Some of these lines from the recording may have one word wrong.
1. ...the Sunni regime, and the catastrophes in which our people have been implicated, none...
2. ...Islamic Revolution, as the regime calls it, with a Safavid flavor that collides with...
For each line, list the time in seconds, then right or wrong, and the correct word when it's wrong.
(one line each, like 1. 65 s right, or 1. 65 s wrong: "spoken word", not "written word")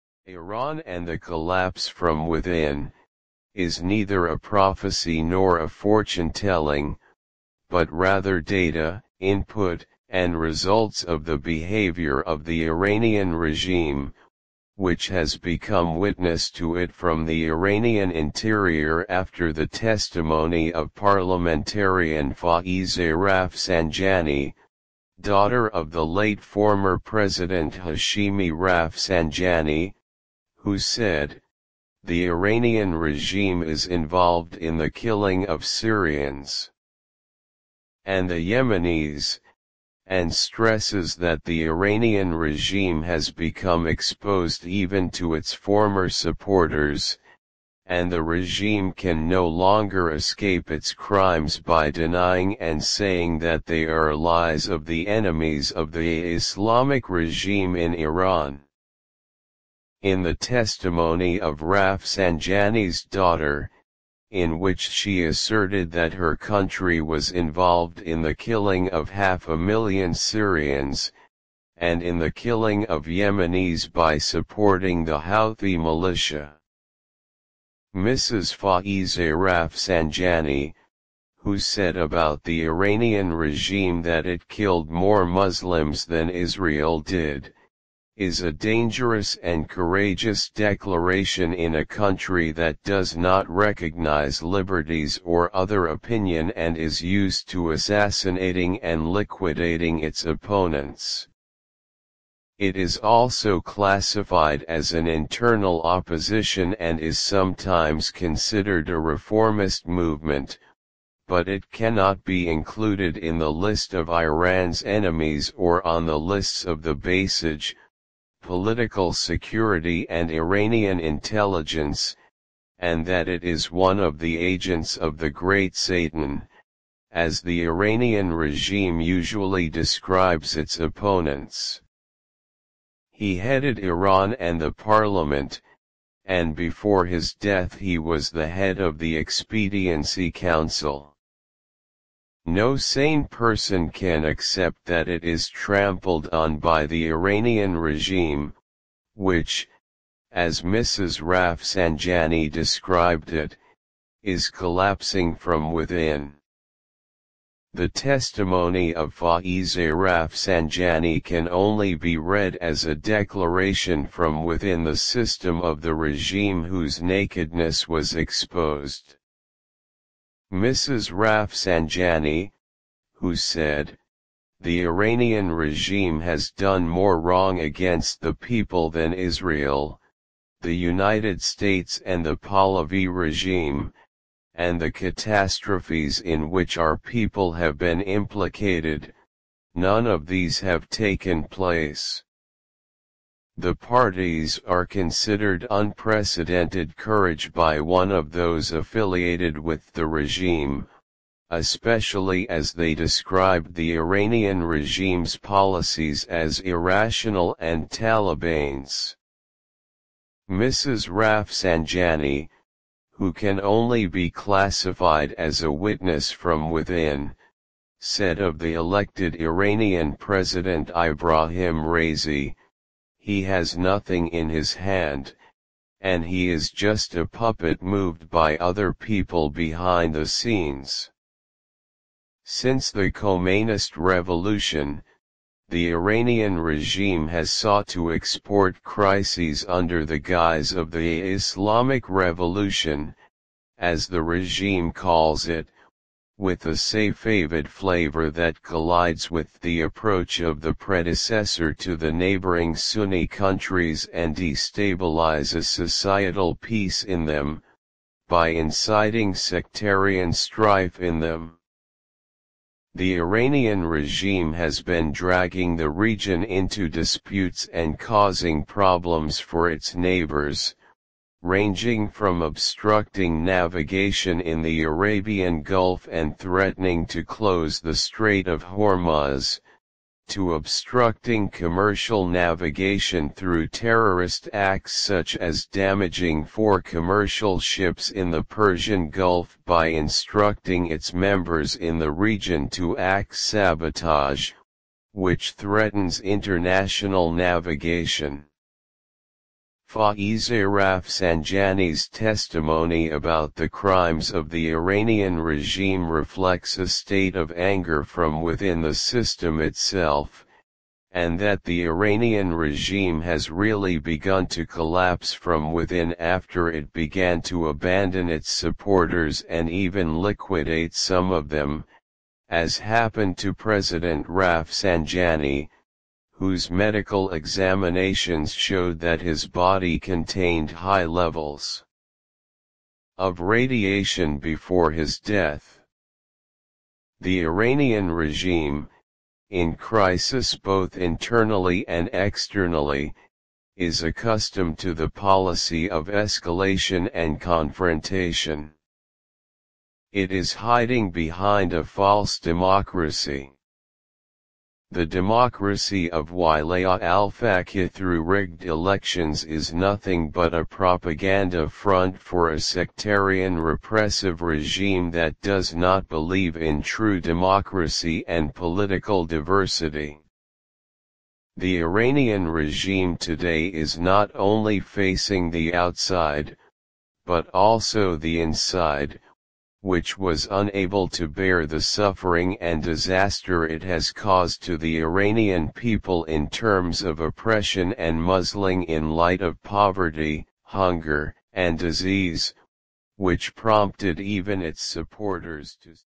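1. 182 s wrong: "Pahlavi", not "Sunni"
2. 241 s right.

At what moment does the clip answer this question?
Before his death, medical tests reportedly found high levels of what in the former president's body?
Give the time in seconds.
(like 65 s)
333 s.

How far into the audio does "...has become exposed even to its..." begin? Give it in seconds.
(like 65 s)
43 s.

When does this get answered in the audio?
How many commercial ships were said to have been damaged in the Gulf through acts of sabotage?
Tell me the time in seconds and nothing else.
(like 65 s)
286 s.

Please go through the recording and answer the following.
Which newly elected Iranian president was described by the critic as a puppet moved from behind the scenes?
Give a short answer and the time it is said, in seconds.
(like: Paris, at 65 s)
Ibrahim Raisi, at 220 s.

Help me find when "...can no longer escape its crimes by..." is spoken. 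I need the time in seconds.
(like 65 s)
48 s.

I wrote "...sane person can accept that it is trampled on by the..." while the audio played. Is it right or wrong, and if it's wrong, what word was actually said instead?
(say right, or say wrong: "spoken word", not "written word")
right.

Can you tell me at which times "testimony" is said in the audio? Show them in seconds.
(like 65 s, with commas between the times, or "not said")
19 s, 60 s, 157 s, 302 s.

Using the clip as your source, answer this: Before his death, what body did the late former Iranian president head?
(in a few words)
the Expediency Council.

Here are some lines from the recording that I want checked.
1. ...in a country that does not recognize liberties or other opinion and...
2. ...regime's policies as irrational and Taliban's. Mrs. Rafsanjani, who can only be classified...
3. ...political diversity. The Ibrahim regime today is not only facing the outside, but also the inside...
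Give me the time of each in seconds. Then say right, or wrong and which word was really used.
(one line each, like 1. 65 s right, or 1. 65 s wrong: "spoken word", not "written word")
1. 91 s right
2. 204 s right
3. 368 s wrong: "Iranian", not "Ibrahim".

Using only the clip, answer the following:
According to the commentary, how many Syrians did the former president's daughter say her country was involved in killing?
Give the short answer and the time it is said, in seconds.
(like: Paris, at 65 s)
half a million, at 69 s.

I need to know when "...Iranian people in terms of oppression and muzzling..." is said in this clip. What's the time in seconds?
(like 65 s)
385 s.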